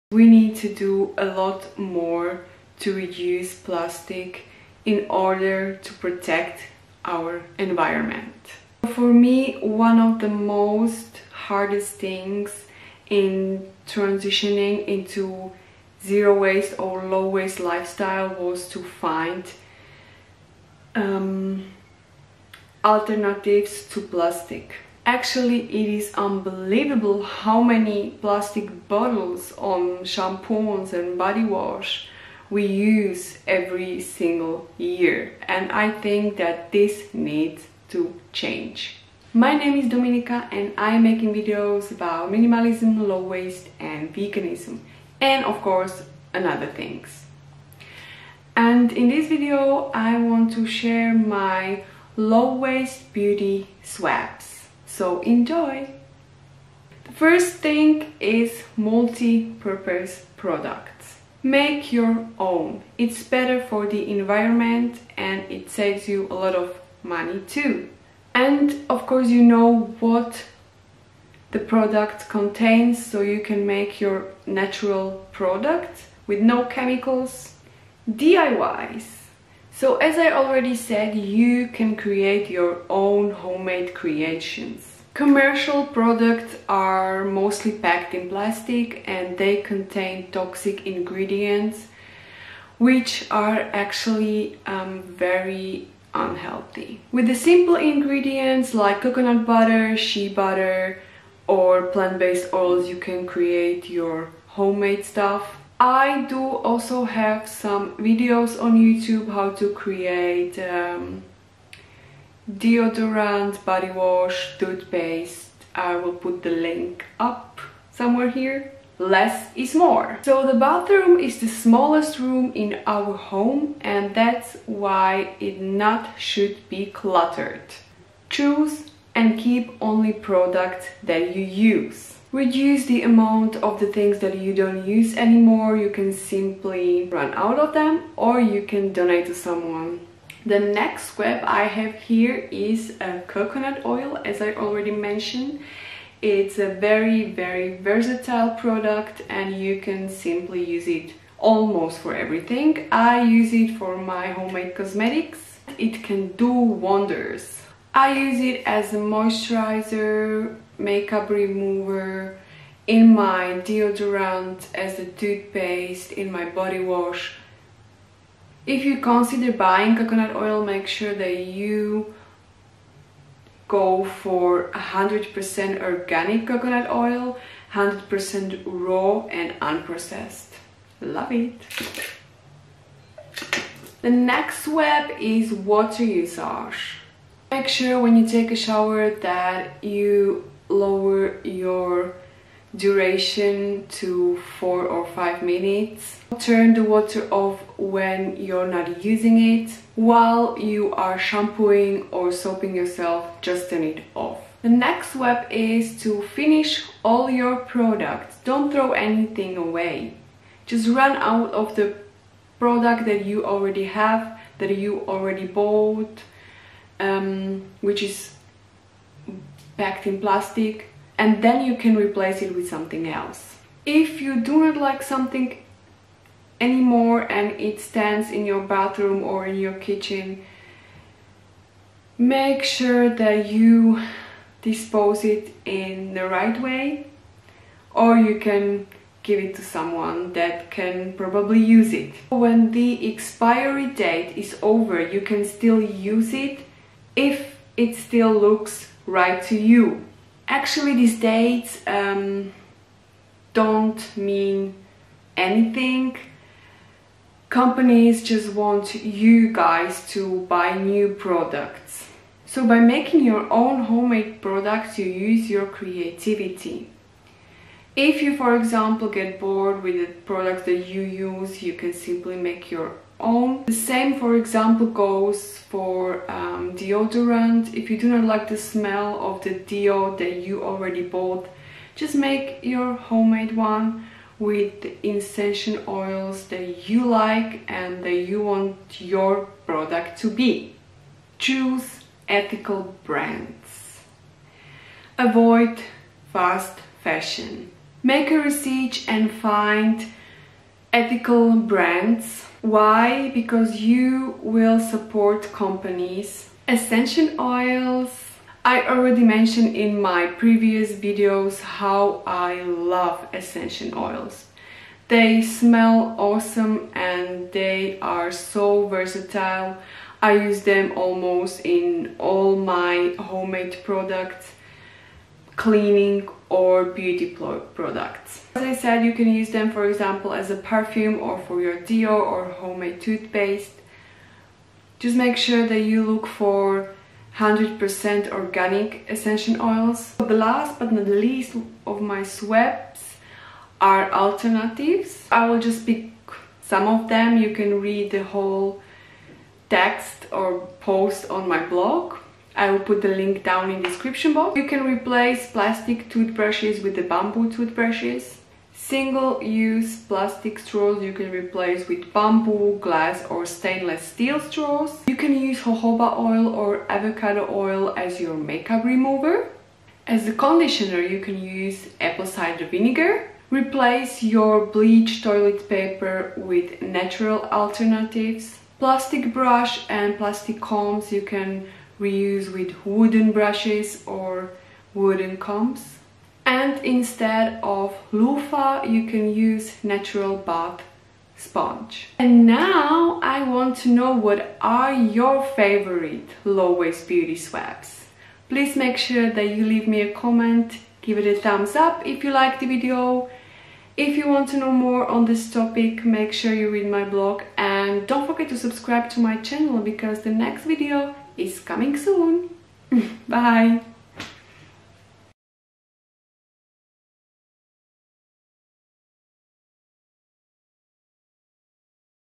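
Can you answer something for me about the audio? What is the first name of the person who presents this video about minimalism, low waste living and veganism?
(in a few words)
Dominika.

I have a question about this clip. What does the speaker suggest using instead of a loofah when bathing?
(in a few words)
natural bath sponge.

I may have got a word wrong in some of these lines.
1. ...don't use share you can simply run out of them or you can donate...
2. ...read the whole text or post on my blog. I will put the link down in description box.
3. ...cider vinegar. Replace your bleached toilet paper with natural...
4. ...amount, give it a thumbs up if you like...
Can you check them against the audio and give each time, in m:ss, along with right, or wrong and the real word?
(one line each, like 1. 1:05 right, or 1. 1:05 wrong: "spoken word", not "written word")
1. 2:14 wrong: "anymore", not "share"
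2. 5:47 right
3. 6:12 right
4. 6:40 wrong: "comment", not "amount".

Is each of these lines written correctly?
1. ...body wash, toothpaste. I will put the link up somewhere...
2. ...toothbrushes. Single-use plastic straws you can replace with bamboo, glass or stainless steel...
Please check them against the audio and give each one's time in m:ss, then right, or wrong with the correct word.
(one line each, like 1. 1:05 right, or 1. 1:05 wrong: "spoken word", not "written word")
1. 1:53 right
2. 5:57 right.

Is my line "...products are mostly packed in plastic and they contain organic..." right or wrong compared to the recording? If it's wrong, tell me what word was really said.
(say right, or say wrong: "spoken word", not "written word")
wrong: "toxic", not "organic".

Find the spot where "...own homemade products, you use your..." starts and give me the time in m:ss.
4:23.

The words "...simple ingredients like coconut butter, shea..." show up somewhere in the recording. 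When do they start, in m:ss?
1:37.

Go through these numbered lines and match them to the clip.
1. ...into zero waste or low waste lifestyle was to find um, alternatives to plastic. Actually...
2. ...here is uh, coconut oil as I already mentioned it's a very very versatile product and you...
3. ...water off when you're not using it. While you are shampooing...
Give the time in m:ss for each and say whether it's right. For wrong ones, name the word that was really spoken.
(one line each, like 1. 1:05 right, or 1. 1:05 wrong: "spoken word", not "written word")
1. 0:14 right
2. 2:21 right
3. 3:16 right.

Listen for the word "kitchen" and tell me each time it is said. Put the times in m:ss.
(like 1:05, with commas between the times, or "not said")
3:49.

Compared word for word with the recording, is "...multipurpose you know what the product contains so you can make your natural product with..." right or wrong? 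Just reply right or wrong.
wrong.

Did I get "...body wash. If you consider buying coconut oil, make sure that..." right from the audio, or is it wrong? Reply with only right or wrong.
right.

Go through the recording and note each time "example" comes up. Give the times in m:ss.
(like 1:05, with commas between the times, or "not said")
4:28, 4:34, 5:29.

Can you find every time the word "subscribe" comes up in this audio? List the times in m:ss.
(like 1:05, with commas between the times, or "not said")
6:48.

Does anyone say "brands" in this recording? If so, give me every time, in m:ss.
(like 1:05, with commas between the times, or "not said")
4:53, 5:01.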